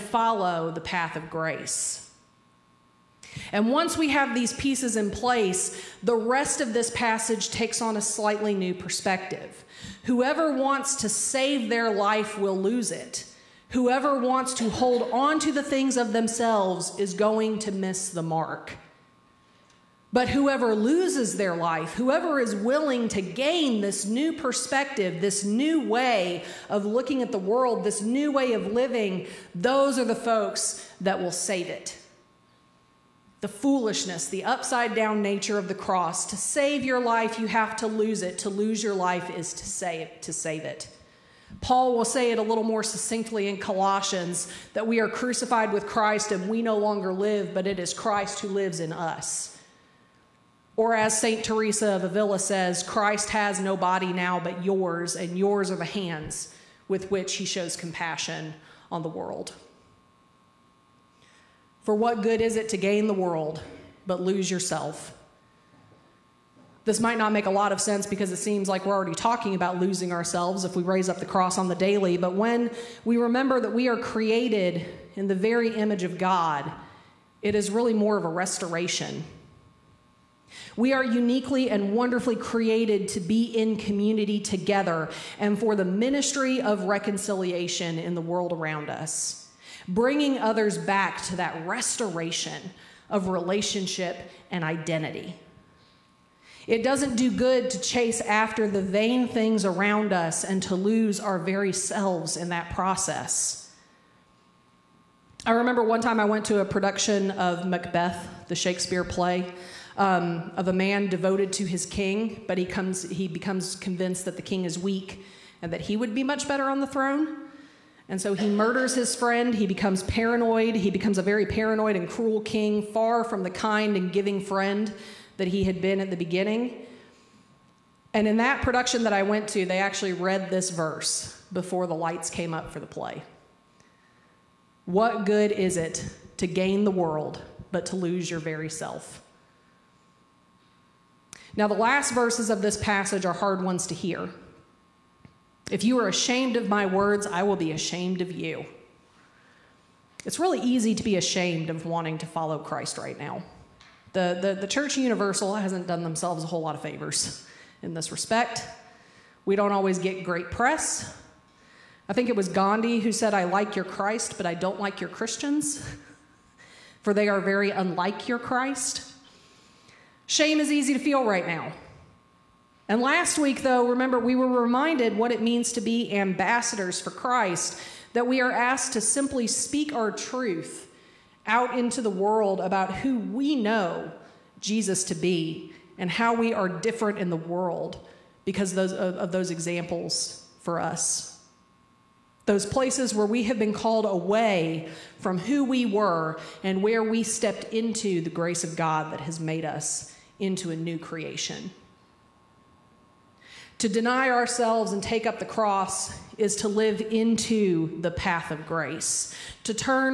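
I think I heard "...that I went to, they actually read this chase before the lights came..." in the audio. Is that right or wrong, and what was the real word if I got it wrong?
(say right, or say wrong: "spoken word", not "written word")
wrong: "verse", not "chase".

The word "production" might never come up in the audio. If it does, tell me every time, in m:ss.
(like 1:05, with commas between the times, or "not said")
1:46, 2:08.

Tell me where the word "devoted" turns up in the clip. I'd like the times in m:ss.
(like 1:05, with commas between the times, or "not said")
1:51.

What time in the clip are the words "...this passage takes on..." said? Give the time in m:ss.
0:06.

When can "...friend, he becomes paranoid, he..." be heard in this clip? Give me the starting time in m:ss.
1:59.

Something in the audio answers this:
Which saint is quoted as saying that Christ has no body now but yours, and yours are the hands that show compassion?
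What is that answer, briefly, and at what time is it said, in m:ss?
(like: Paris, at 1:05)
St. Teresa of Avila, at 0:51.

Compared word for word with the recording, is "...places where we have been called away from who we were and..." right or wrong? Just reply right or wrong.
right.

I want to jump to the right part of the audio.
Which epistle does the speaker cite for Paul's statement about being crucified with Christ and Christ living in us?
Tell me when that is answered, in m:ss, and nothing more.
0:43.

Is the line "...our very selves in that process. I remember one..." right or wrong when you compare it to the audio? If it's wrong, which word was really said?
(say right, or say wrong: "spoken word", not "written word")
right.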